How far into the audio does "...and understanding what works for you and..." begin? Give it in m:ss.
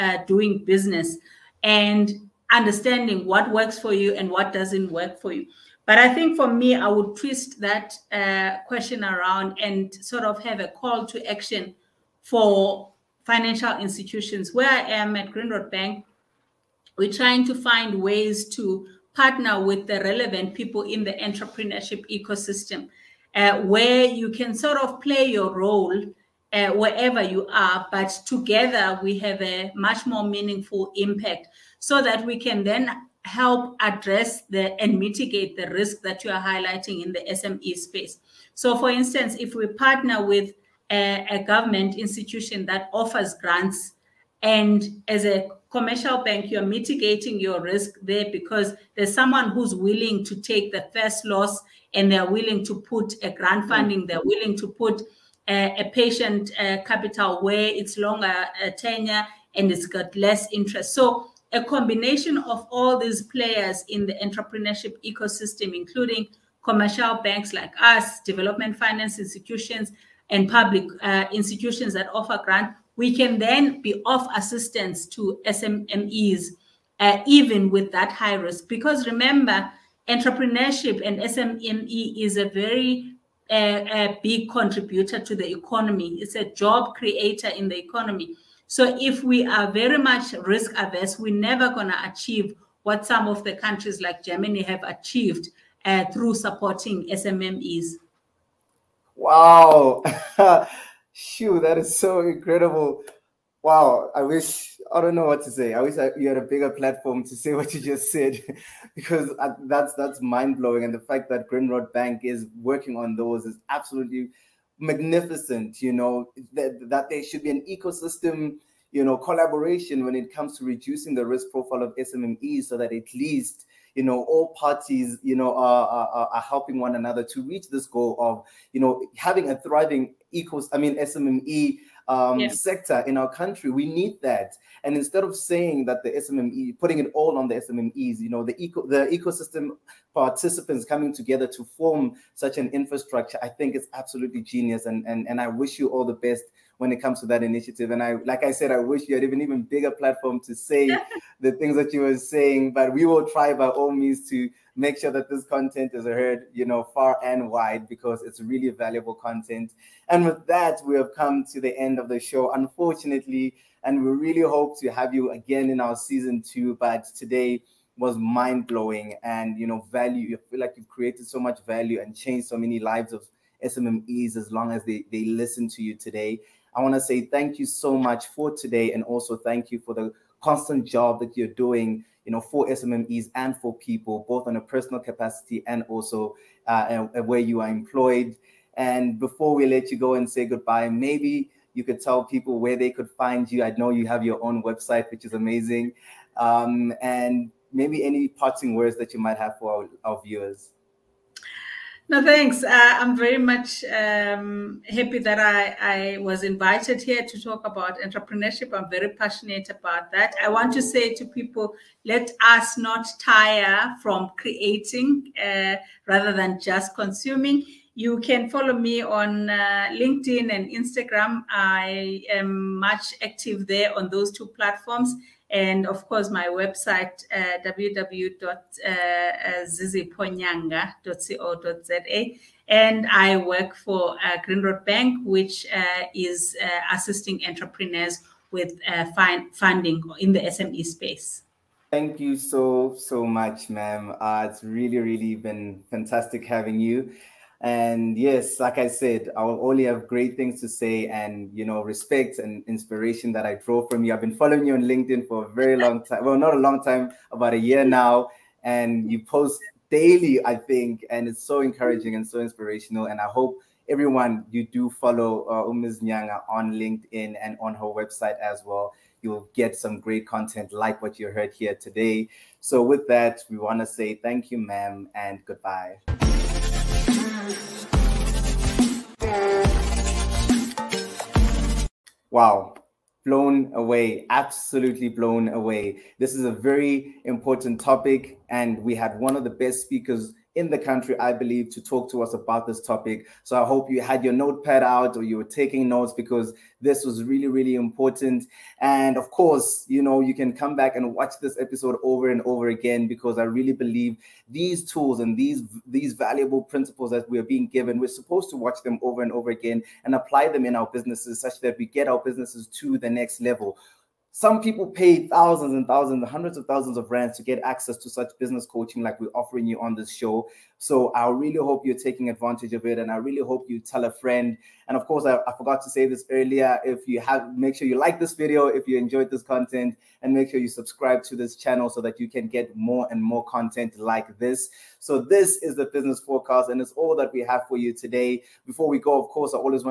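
0:01.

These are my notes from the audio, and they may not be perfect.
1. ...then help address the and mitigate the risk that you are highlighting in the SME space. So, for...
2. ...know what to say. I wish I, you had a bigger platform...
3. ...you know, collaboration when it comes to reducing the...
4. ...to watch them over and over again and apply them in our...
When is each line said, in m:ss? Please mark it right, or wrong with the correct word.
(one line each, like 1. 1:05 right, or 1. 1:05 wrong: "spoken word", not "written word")
1. 0:32 right
2. 1:45 right
3. 1:58 right
4. 5:08 right.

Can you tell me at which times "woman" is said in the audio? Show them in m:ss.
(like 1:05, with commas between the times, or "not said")
not said.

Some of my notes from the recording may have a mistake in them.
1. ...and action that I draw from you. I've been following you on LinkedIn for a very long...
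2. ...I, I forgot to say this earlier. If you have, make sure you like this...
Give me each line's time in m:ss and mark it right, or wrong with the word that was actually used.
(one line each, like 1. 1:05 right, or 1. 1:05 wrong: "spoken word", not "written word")
1. 4:12 wrong: "inspiration", not "action"
2. 5:25 right.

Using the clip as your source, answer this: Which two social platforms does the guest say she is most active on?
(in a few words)
LinkedIn and Instagram.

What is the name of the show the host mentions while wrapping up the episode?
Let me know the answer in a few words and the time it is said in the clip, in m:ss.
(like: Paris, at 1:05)
The Business Forecast, at 5:35.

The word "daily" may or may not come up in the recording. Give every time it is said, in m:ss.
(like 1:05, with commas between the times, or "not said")
4:19.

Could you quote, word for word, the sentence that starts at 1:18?
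Because remember, entrepreneurship and SME is a very uh, uh, big contributor to the economy.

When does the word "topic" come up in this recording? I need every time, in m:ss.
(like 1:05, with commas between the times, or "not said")
4:47, 4:52.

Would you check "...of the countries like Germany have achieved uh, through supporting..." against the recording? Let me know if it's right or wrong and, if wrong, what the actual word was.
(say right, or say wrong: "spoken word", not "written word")
right.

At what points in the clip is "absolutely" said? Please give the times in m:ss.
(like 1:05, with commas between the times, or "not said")
1:53, 2:23, 4:44.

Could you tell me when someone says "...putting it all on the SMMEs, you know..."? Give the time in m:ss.
2:16.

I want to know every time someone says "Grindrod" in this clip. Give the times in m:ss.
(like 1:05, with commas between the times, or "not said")
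0:15, 1:51, 3:54.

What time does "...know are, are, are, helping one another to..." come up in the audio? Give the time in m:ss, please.
2:05.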